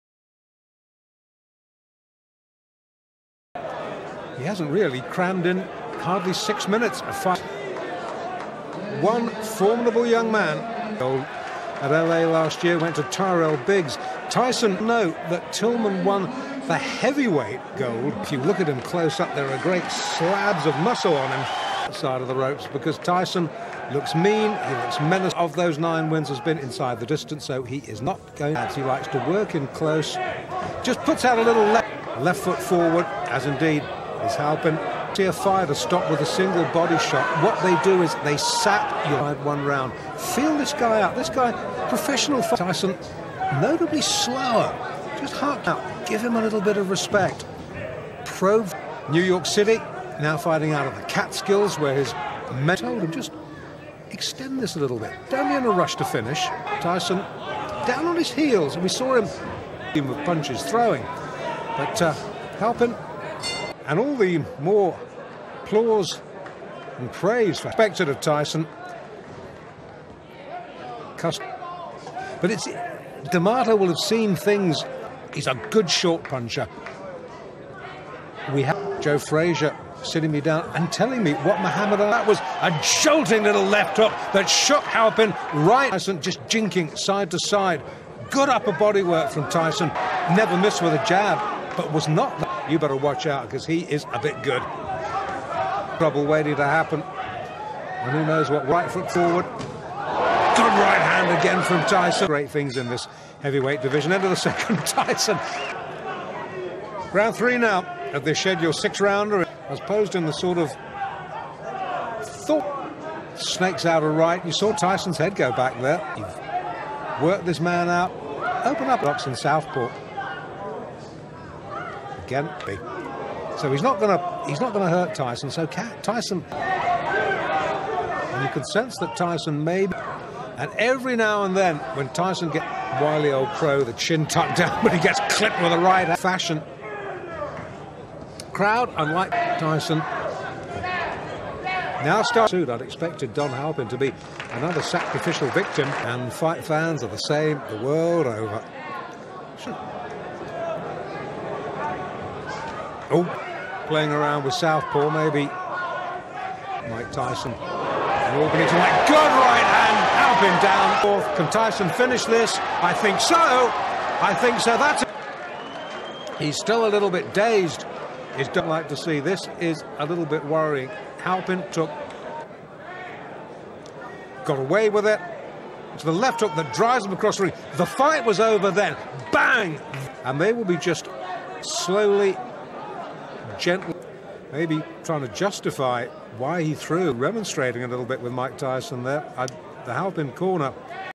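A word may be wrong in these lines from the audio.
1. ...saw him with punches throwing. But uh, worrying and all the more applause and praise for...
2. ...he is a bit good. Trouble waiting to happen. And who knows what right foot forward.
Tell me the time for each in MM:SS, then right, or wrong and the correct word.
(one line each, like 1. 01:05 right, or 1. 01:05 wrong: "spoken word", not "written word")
1. 00:58 wrong: "helping", not "worrying"
2. 01:33 right.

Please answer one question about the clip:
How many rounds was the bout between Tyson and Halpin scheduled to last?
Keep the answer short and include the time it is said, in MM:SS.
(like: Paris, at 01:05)
6, at 01:48.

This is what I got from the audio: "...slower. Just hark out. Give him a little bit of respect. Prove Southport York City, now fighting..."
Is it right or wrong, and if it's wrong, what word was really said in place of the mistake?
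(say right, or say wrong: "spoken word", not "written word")
wrong: "New", not "Southport".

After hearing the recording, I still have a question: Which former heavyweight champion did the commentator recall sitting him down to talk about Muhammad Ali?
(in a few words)
Joe Frazier.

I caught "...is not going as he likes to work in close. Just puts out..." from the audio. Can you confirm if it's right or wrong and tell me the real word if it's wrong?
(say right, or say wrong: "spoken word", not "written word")
right.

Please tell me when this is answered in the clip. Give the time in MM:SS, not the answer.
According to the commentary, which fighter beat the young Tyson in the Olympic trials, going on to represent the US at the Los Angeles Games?
00:13.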